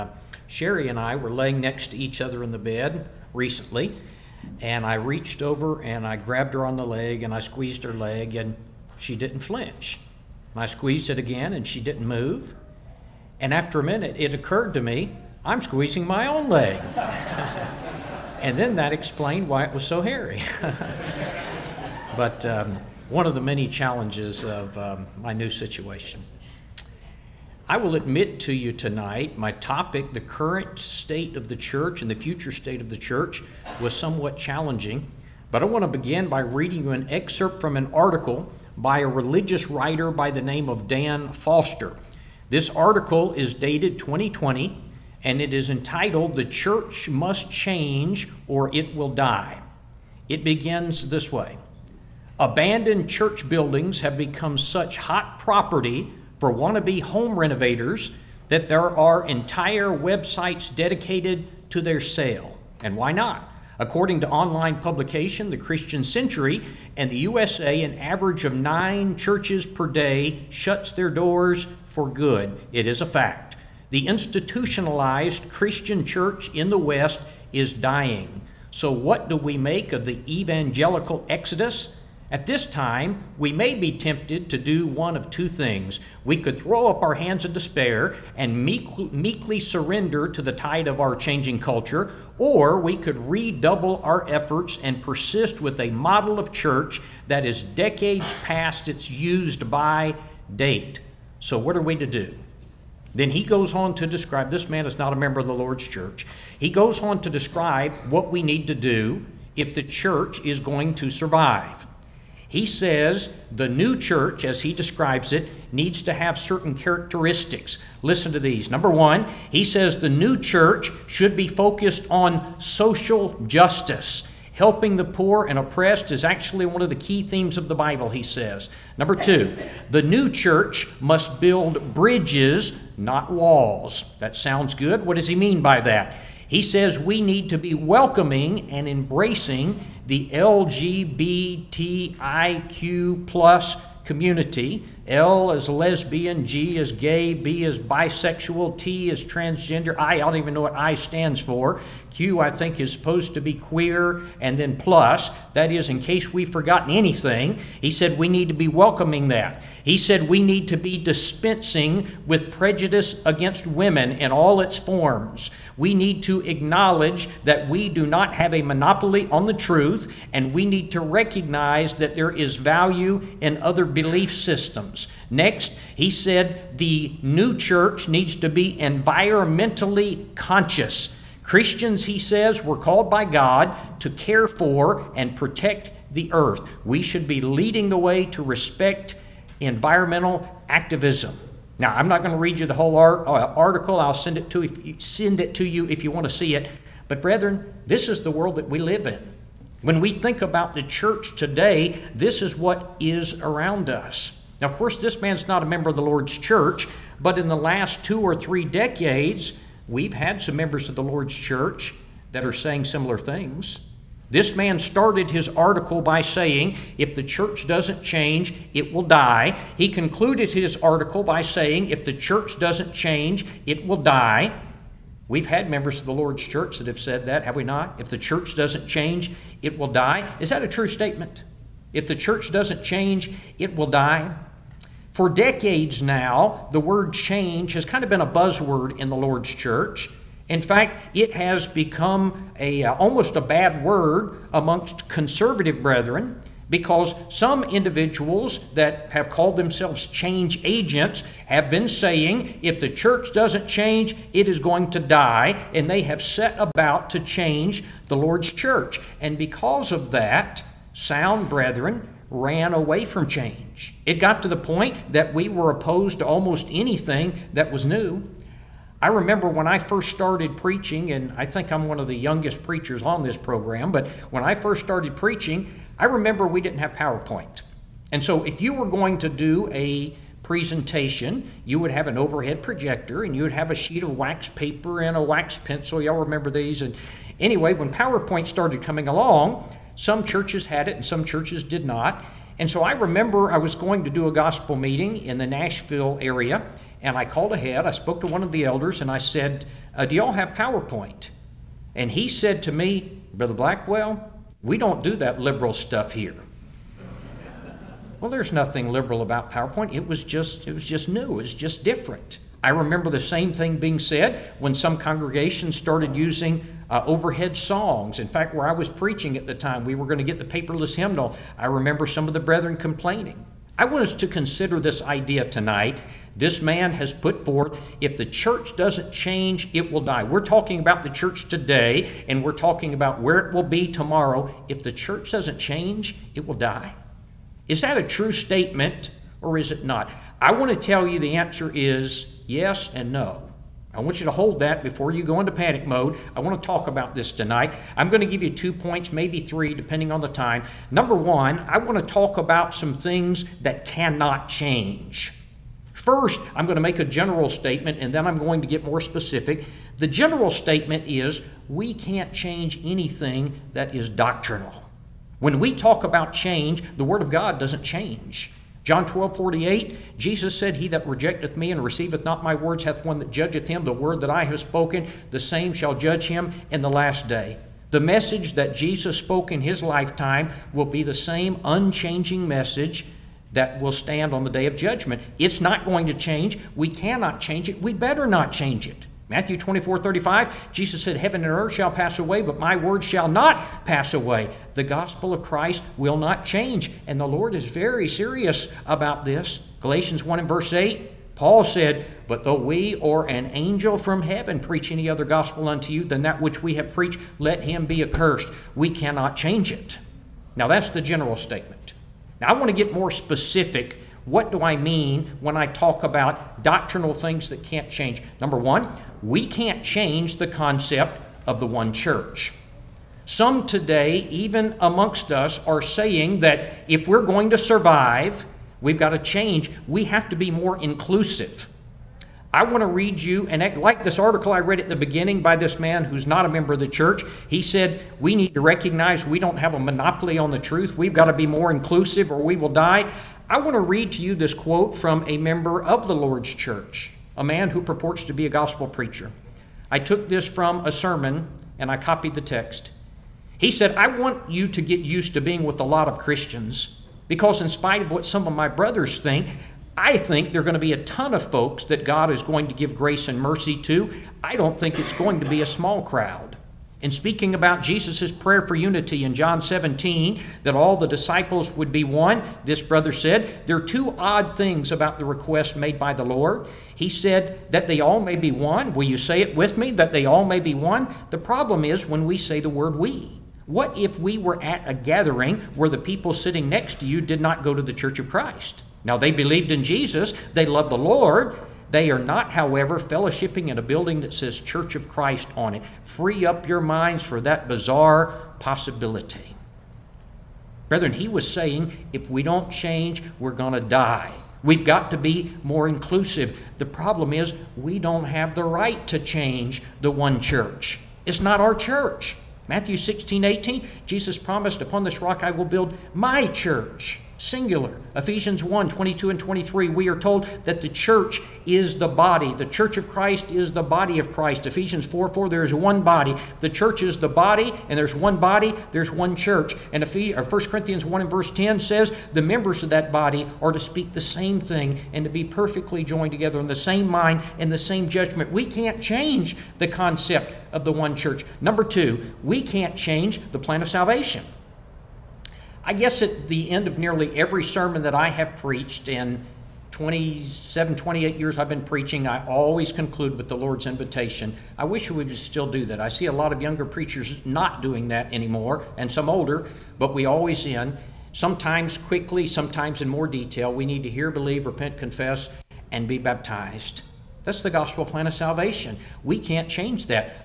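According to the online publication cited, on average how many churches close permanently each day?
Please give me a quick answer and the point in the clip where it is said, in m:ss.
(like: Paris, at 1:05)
9, at 1:08.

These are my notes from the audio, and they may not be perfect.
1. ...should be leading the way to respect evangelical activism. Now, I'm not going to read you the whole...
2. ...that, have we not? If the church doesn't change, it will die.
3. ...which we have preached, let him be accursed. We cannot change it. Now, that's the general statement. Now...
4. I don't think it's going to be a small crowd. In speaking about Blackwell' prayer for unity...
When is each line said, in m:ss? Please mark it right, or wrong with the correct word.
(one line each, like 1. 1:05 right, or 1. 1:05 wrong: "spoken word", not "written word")
1. 3:07 wrong: "environmental", not "evangelical"
2. 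3:47 right
3. 6:46 right
4. 7:44 wrong: "Jesus", not "Blackwell".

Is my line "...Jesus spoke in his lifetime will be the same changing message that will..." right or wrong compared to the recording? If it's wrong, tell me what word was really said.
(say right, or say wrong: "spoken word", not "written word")
wrong: "unchanging", not "changing".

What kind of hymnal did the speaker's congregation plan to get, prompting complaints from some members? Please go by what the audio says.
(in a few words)
Paperless hymnal.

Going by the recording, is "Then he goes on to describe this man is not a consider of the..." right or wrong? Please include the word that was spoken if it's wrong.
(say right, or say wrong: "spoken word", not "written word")
wrong: "member", not "consider".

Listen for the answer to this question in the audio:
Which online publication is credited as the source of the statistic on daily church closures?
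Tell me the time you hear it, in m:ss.
1:05.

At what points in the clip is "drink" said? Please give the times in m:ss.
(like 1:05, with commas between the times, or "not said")
not said.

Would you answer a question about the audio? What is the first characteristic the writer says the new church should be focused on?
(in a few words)
Social justice.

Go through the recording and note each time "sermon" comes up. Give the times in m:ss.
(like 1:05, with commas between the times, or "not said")
7:30, 9:07.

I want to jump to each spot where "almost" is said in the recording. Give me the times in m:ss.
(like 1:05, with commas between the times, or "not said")
4:02, 4:26.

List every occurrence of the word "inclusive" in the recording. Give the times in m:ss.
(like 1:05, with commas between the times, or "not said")
7:10, 7:21, 8:25.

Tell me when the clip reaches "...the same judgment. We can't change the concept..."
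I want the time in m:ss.
8:57.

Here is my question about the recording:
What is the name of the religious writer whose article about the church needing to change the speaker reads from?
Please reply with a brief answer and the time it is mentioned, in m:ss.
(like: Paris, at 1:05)
Dan Foster, at 0:40.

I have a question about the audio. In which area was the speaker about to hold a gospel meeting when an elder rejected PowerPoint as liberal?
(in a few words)
Nashville.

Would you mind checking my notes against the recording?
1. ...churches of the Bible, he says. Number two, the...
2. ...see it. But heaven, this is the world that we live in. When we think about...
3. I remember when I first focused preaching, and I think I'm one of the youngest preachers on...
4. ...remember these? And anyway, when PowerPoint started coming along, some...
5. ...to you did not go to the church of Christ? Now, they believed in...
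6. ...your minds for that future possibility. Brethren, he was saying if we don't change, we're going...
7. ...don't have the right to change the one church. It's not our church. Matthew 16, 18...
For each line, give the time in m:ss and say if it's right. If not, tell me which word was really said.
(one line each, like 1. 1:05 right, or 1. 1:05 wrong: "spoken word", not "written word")
1. 2:07 wrong: "themes", not "churches"
2. 3:16 wrong: "brethren", not "heaven"
3. 4:29 wrong: "started", not "focused"
4. 4:46 right
5. 8:07 right
6. 8:16 wrong: "bizarre", not "future"
7. 8:27 right.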